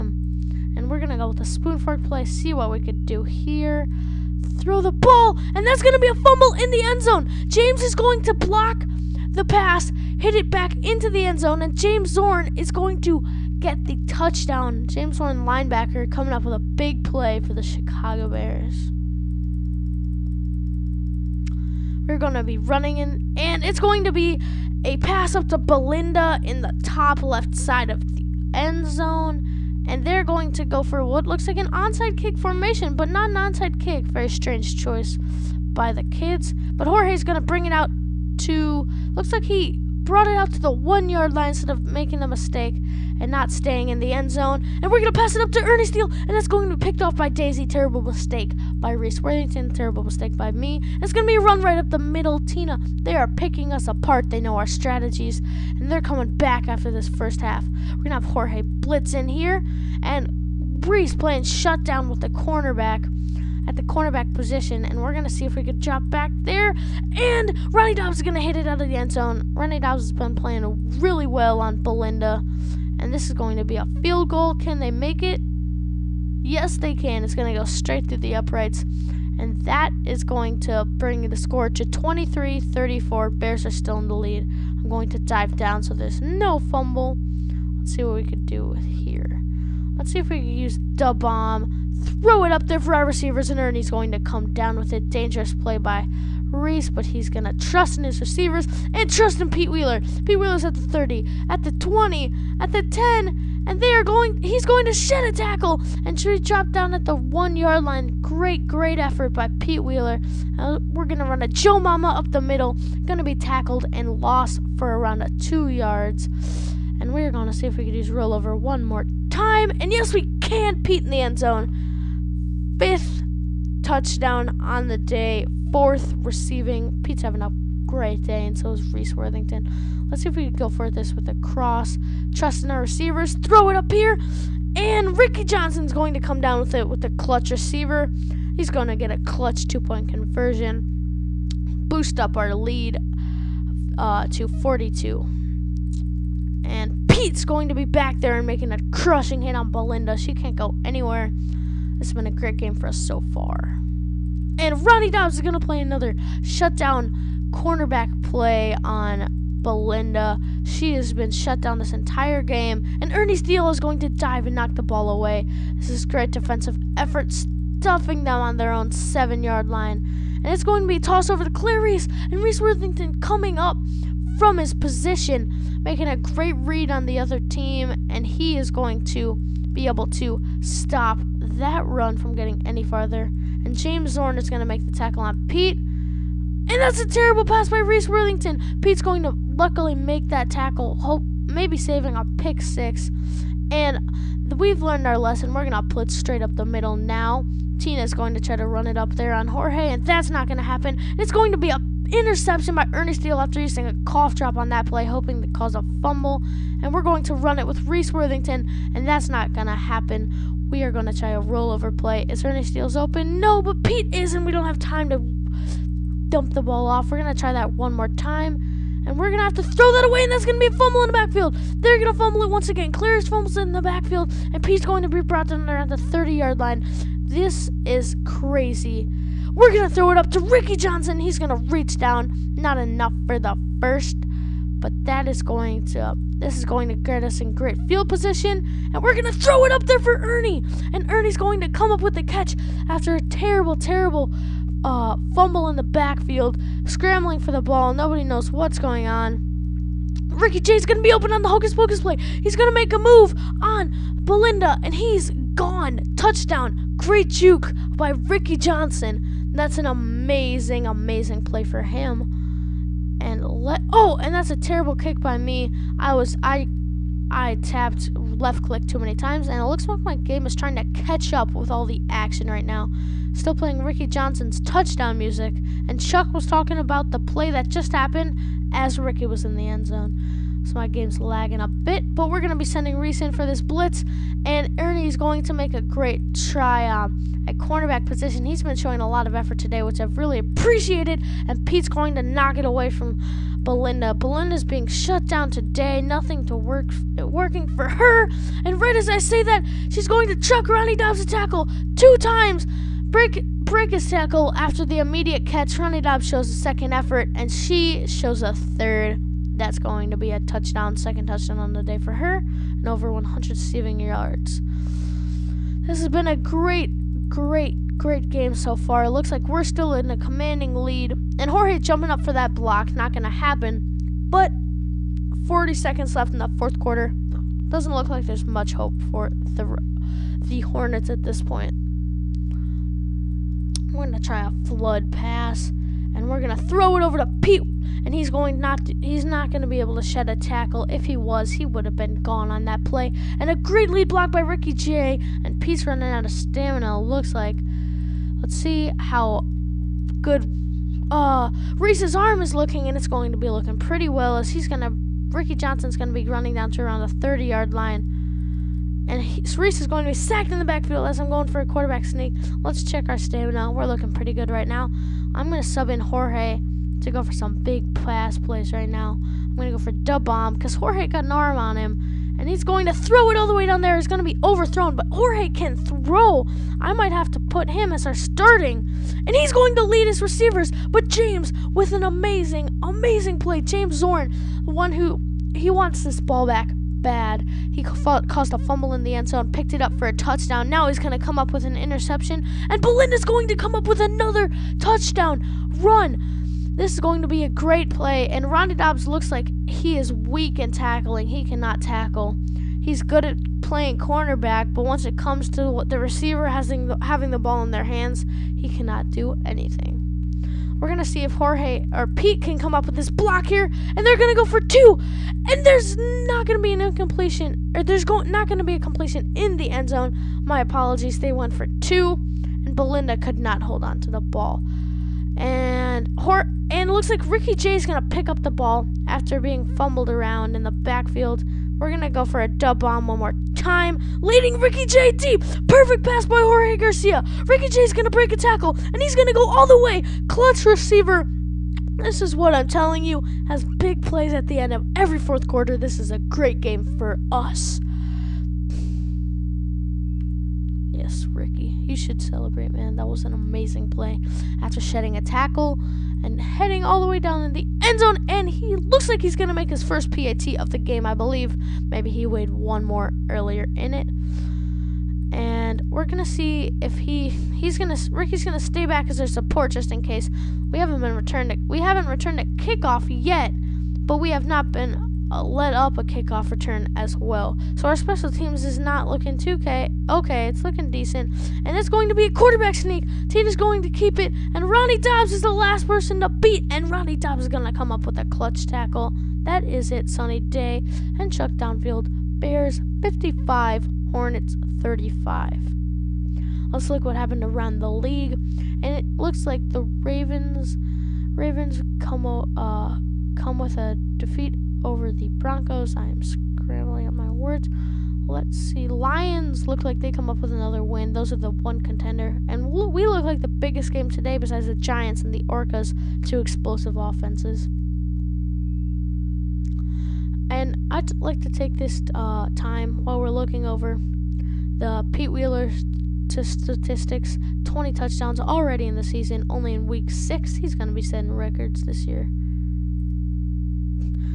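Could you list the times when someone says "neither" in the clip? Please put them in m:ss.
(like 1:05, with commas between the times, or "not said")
not said.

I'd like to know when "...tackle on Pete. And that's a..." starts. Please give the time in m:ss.
3:04.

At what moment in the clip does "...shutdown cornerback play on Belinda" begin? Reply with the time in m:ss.
2:36.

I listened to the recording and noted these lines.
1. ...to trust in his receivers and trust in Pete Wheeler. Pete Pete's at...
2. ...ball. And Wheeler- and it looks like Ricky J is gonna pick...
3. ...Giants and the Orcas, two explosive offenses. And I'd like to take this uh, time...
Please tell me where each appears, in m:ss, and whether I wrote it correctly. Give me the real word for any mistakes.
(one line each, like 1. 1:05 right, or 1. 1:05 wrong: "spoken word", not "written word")
1. 1:37 wrong: "Wheeler", not "Pete"
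2. 7:04 wrong: "Hor", not "Wheeler"
3. 8:34 right.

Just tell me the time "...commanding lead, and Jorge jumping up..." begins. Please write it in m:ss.
5:20.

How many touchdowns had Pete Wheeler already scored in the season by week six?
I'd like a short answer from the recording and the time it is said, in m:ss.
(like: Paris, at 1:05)
20, at 8:47.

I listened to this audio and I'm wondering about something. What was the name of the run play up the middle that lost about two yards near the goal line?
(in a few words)
Joe Mama.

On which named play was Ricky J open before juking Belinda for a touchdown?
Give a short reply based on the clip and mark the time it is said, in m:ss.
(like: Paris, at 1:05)
Hocus Pocus, at 4:11.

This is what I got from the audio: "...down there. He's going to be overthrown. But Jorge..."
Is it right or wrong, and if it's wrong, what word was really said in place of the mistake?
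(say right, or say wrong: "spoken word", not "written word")
right.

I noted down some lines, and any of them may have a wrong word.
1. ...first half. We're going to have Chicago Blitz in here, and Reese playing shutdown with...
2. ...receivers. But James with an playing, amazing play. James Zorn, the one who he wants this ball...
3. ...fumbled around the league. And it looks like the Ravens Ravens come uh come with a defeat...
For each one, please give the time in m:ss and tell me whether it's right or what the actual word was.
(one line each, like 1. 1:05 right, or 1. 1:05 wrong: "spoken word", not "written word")
1. 0:57 wrong: "Jorge", not "Chicago"
2. 6:20 wrong: "amazing", not "playing"
3. 8:17 wrong: "happened", not "fumbled".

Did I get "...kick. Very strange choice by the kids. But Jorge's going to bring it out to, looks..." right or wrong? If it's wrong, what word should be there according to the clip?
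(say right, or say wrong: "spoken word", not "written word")
right.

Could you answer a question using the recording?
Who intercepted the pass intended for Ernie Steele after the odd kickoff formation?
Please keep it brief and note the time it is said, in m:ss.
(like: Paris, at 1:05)
Daisy, at 0:47.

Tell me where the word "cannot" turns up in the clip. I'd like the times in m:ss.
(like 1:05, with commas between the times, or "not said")
6:41, 6:48.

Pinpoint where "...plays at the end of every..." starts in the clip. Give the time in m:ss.
7:24.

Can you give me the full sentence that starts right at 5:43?
And a great lead block by Ricky J.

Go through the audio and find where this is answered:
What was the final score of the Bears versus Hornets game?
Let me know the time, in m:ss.
8:12.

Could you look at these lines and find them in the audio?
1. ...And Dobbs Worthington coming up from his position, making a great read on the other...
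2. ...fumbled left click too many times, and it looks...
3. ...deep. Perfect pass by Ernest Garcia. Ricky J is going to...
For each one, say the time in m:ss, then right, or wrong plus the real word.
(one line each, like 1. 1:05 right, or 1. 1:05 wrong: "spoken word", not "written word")
1. 2:52 wrong: "Reese", not "Dobbs"
2. 4:27 wrong: "tapped", not "fumbled"
3. 7:15 wrong: "Jorge", not "Ernest".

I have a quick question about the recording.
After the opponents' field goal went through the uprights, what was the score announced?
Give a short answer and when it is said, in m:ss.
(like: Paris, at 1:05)
23 34, at 1:21.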